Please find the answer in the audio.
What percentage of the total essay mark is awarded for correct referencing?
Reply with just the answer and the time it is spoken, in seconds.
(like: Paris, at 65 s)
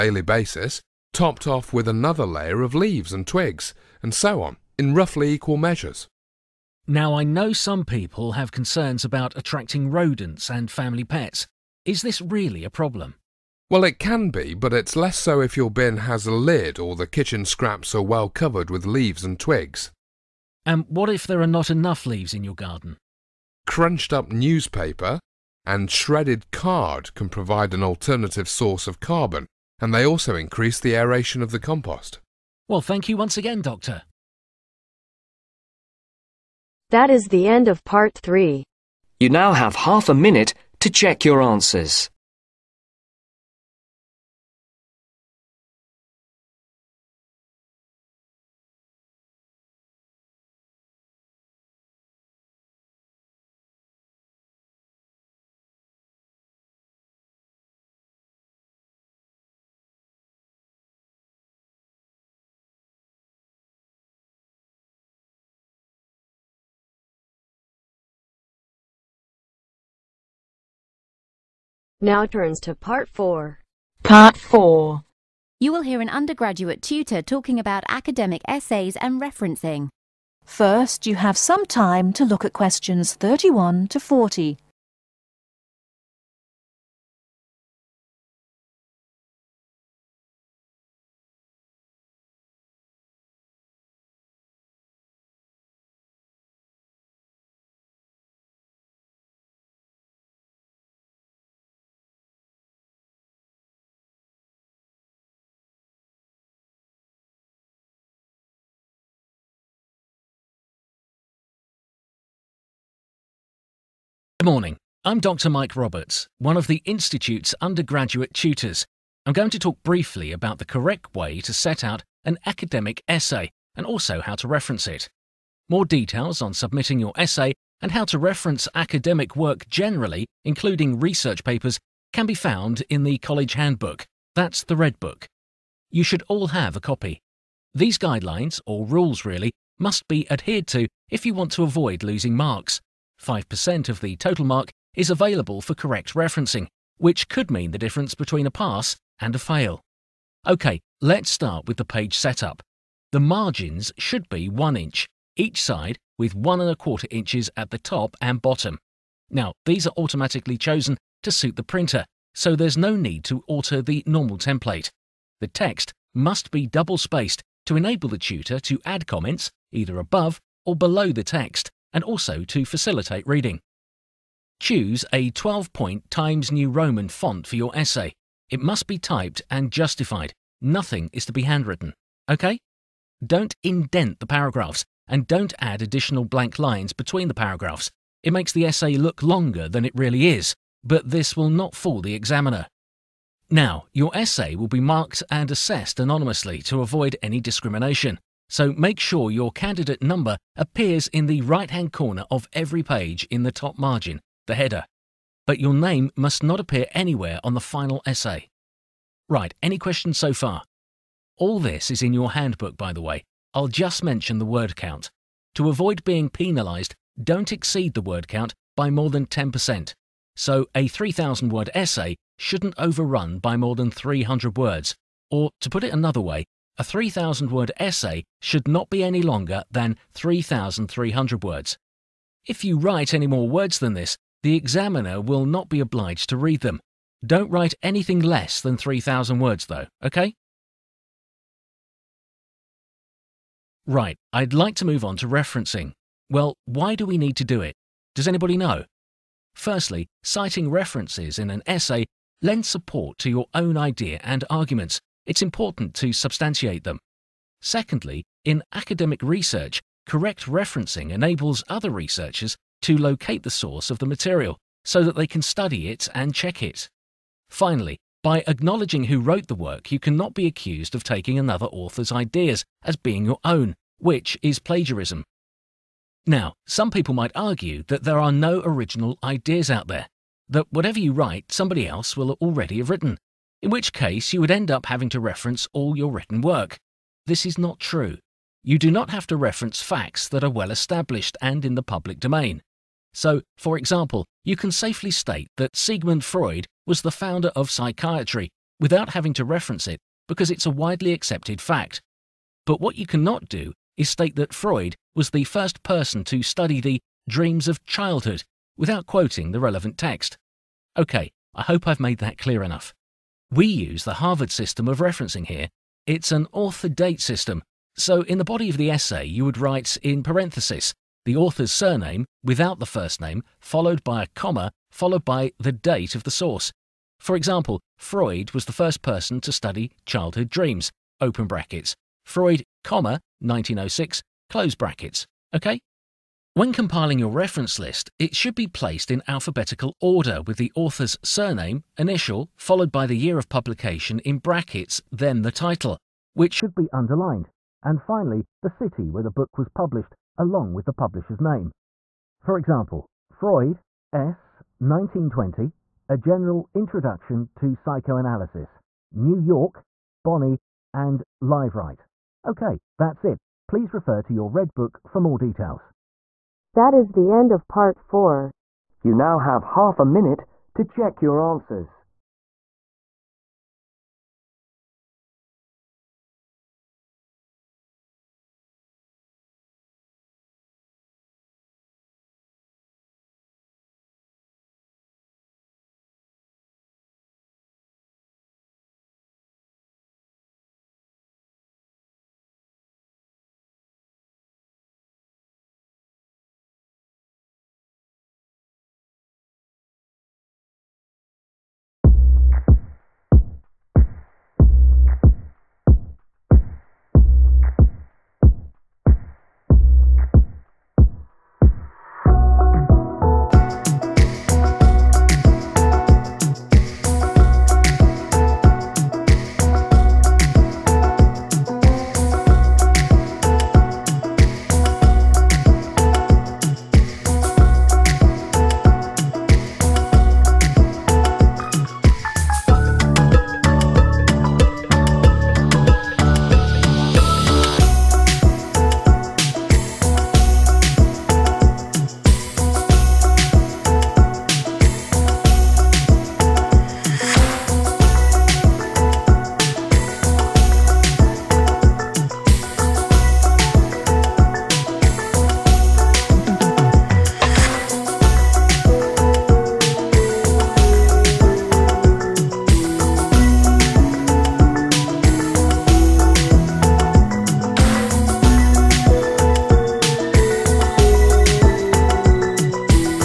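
5%, at 143 s.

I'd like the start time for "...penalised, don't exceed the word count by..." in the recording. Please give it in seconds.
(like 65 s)
216 s.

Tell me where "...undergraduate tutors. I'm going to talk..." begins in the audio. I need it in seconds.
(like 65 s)
117 s.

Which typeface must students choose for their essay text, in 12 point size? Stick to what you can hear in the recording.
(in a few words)
Times New Roman.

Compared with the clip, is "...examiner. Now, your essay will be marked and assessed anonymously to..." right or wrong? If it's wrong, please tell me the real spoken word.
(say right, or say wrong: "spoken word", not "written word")
right.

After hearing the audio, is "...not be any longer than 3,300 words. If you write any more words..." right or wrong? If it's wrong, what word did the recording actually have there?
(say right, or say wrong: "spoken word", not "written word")
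right.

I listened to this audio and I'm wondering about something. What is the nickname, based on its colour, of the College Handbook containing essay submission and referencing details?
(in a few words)
the Red Book.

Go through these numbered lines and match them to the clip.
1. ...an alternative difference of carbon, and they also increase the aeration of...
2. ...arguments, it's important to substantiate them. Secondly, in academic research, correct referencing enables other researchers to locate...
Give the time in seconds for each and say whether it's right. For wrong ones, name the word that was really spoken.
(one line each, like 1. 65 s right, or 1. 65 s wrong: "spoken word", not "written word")
1. 27 s wrong: "source", not "difference"
2. 254 s right.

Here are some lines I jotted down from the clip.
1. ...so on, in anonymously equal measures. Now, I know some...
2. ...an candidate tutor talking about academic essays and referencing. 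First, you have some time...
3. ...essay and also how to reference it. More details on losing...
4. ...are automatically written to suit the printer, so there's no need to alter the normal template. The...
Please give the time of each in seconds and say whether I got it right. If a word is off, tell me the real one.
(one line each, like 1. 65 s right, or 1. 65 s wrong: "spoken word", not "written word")
1. 4 s wrong: "roughly", not "anonymously"
2. 76 s wrong: "undergraduate", not "candidate"
3. 123 s wrong: "submitting", not "losing"
4. 159 s wrong: "chosen", not "written".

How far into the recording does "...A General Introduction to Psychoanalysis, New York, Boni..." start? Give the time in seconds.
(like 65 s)
356 s.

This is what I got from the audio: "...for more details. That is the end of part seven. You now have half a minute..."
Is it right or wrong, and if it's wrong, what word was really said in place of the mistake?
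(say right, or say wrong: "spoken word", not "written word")
wrong: "four", not "seven".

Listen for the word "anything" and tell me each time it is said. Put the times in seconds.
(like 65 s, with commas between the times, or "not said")
237 s.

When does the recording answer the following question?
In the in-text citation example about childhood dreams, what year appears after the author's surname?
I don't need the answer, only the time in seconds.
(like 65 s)
333 s.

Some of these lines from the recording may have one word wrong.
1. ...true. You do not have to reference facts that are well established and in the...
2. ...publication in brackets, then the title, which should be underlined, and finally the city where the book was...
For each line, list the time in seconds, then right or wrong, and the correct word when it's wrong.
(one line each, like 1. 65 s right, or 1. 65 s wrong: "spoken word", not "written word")
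1. 287 s right
2. 343 s right.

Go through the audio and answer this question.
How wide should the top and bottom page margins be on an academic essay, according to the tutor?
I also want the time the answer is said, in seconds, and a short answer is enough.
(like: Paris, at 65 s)
1.25 inches, at 156 s.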